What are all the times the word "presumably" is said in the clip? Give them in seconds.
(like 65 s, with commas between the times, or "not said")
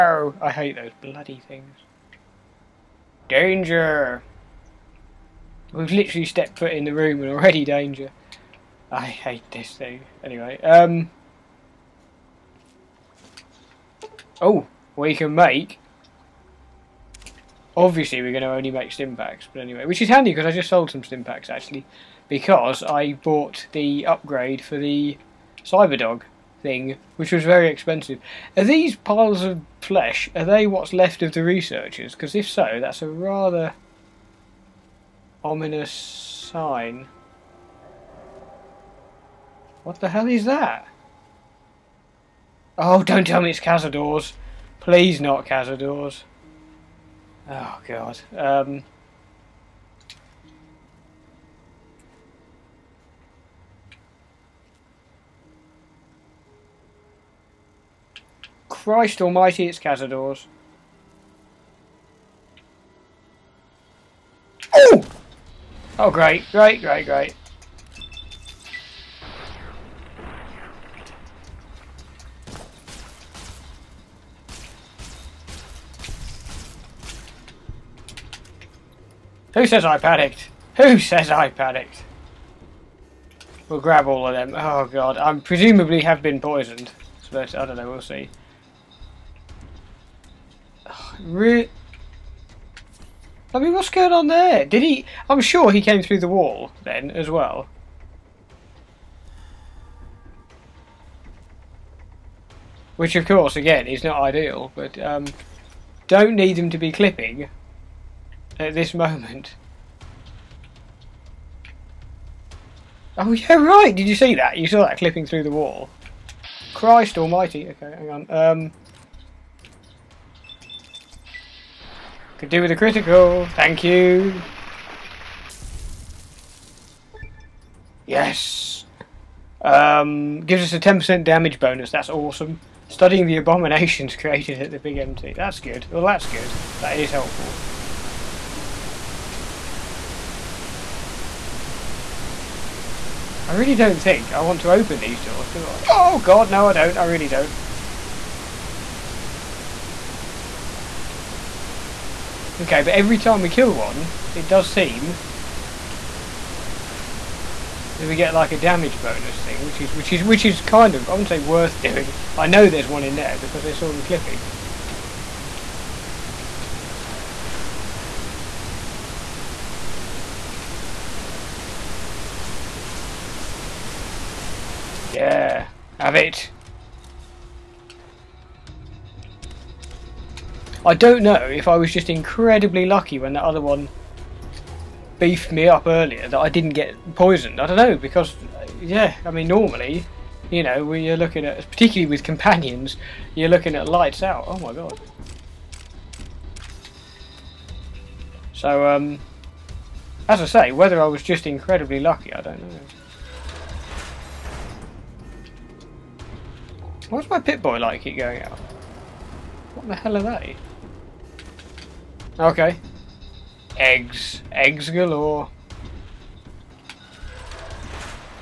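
85 s.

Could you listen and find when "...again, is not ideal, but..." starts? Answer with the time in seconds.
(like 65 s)
103 s.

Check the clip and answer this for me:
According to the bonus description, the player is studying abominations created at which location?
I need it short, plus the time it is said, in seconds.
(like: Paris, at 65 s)
Big MT, at 134 s.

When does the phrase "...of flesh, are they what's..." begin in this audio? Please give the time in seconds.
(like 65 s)
29 s.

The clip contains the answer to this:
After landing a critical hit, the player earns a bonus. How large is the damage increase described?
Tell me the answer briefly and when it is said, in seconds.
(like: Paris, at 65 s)
10%, at 130 s.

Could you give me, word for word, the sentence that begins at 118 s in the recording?
Um, could do with a critical.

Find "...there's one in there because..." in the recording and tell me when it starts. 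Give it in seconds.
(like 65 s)
162 s.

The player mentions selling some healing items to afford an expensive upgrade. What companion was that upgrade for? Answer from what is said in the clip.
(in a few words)
Cyberdog.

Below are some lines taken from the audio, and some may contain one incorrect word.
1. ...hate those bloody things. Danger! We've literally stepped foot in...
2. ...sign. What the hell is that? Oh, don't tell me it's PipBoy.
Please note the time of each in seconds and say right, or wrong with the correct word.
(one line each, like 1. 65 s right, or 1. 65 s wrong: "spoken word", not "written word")
1. 0 s right
2. 35 s wrong: "Cazadors", not "PipBoy".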